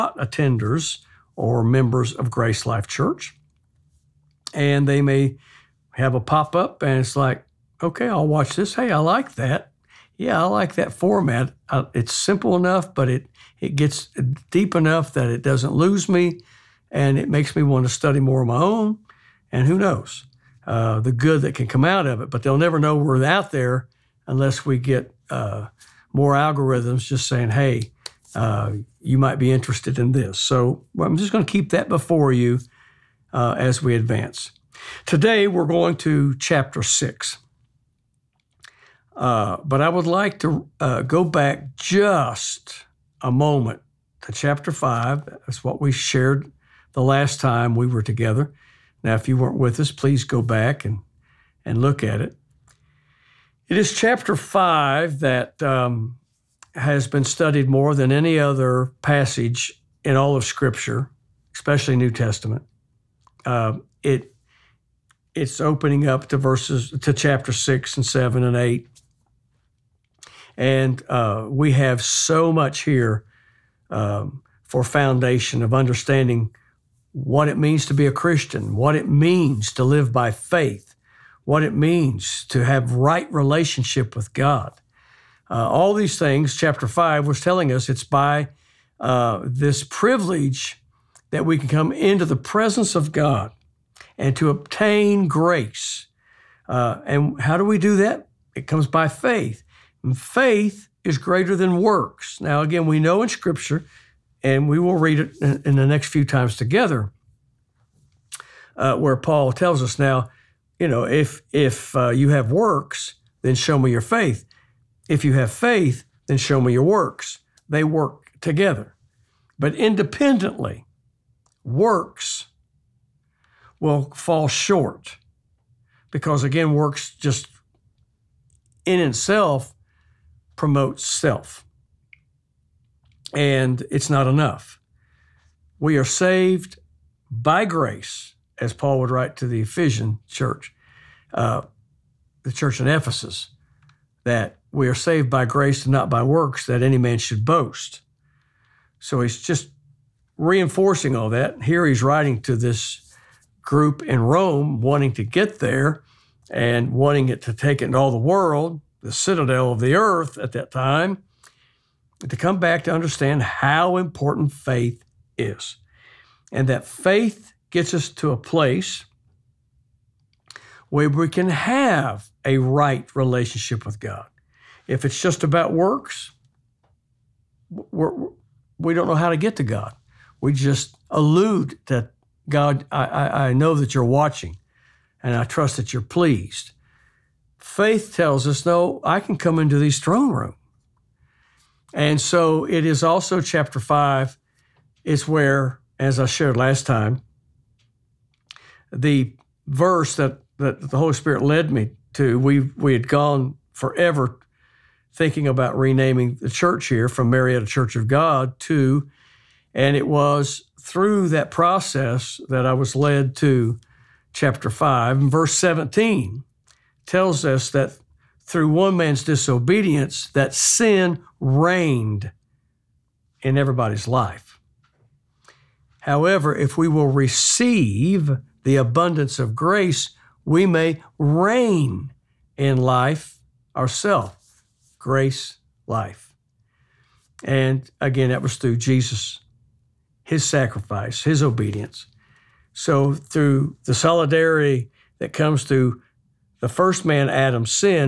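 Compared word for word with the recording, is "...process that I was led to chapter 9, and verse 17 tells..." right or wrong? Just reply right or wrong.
wrong.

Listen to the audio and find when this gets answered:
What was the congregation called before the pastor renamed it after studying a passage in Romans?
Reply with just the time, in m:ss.
3:27.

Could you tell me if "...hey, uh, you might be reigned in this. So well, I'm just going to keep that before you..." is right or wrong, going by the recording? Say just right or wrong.
wrong.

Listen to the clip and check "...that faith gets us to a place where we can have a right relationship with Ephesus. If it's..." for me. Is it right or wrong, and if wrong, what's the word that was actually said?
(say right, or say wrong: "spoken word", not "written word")
wrong: "God", not "Ephesus".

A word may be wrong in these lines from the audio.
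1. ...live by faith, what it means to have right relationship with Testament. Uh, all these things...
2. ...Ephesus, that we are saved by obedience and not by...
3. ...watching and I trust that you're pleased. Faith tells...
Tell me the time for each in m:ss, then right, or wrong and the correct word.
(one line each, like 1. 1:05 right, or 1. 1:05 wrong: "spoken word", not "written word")
1. 1:19 wrong: "God", not "Testament"
2. 2:22 wrong: "grace", not "obedience"
3. 3:04 right.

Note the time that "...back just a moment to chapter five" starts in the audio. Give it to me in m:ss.
0:41.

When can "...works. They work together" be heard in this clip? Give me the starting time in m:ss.
1:56.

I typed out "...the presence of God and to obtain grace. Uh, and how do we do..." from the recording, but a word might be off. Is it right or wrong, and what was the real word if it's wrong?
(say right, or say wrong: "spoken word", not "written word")
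right.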